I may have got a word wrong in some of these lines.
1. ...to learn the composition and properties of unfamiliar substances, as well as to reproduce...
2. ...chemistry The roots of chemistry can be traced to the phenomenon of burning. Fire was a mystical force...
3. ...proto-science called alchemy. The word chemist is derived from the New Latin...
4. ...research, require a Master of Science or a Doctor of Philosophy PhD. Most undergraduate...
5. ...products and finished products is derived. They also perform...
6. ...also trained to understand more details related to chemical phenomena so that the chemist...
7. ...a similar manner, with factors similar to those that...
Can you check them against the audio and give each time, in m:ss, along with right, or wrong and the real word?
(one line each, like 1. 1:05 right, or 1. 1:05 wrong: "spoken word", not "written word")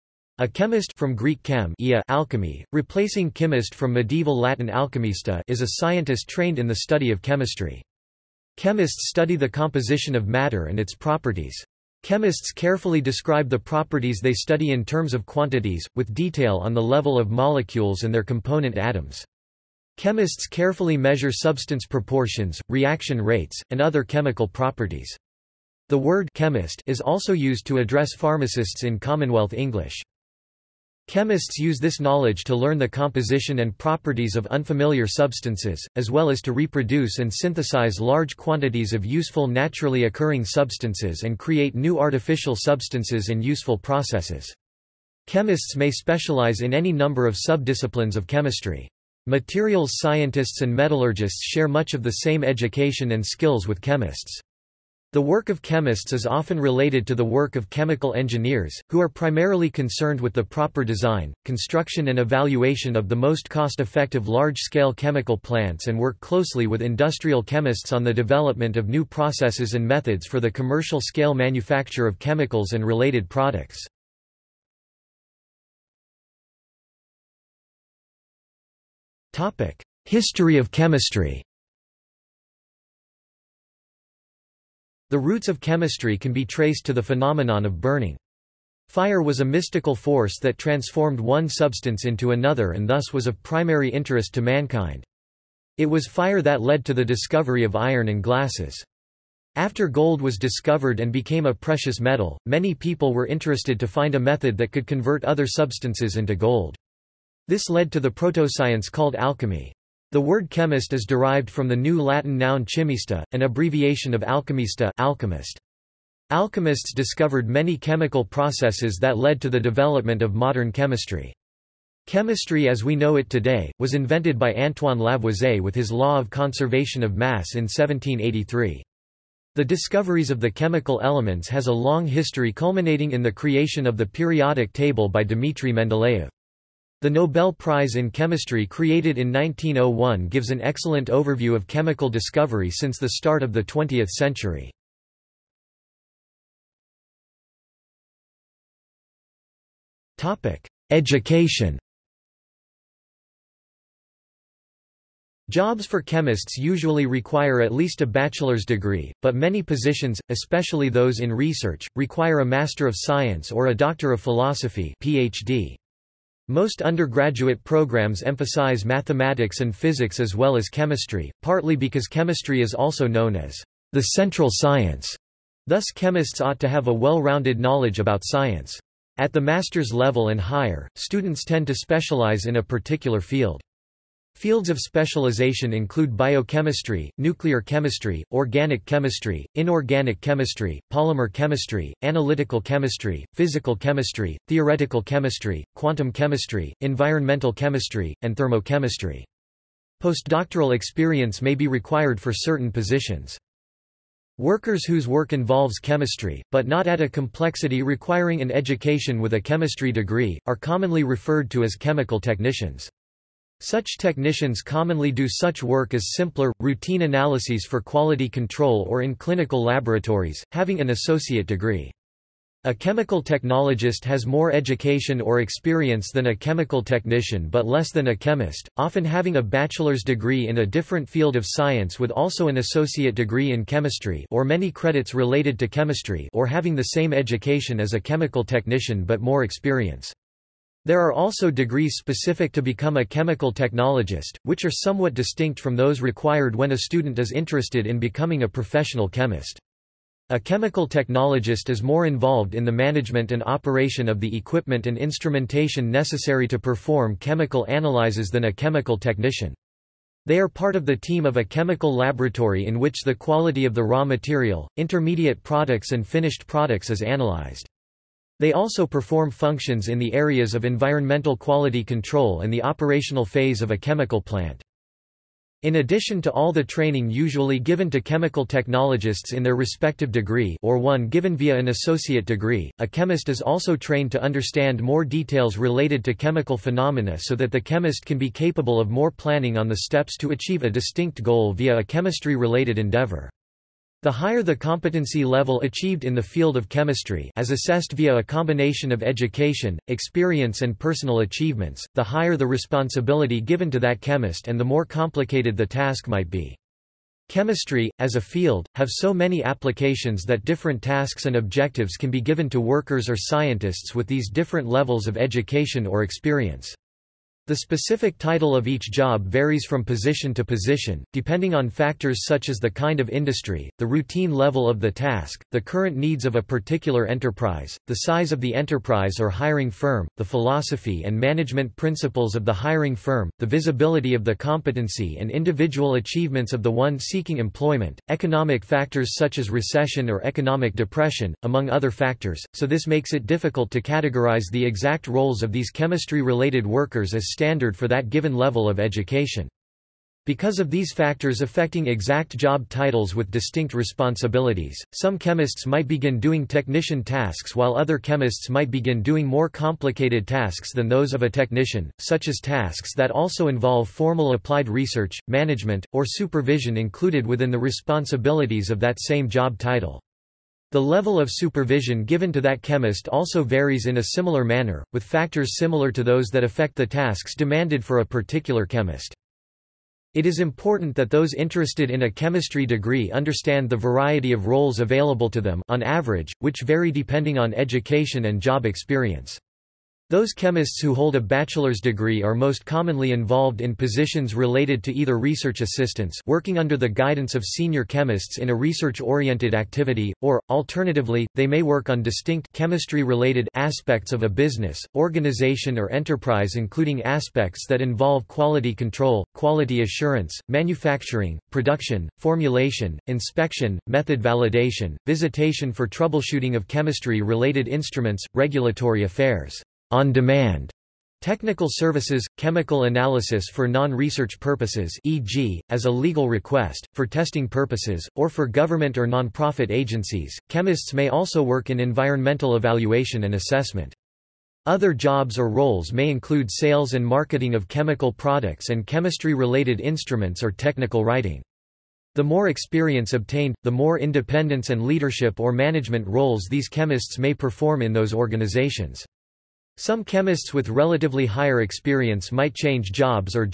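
1. 0:32 right
2. 1:20 right
3. 1:48 right
4. 2:41 right
5. 4:25 wrong: "analyzed", not "derived"
6. 4:43 right
7. 6:13 right.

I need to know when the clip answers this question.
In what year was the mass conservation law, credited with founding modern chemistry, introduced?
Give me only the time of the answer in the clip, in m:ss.
2:07.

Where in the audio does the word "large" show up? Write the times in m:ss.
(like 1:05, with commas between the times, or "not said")
0:37, 1:04.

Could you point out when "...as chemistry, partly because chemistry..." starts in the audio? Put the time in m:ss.
2:50.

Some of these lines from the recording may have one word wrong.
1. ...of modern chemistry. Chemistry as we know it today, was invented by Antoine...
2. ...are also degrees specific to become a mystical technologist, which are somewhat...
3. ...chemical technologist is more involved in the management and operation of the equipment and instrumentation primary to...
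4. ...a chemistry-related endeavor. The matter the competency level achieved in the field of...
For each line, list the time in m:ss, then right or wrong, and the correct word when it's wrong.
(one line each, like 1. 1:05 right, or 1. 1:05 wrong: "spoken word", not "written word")
1. 2:00 right
2. 4:00 wrong: "chemical", not "mystical"
3. 4:10 wrong: "necessary", not "primary"
4. 4:51 wrong: "higher", not "matter".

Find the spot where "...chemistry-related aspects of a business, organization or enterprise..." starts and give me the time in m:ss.
6:42.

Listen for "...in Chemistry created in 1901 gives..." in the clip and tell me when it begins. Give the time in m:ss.
2:17.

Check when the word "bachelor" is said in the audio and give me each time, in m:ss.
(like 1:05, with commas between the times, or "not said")
2:38, 3:49, 6:31.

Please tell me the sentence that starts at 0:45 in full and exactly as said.
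Chemists may specialize in any number of subdisciplines of chemistry.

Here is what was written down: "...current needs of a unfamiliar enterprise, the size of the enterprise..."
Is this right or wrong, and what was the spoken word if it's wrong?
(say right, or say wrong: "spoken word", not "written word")
wrong: "particular", not "unfamiliar".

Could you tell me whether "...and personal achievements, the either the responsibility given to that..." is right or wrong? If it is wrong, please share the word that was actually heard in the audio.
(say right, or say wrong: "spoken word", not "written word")
wrong: "higher", not "either".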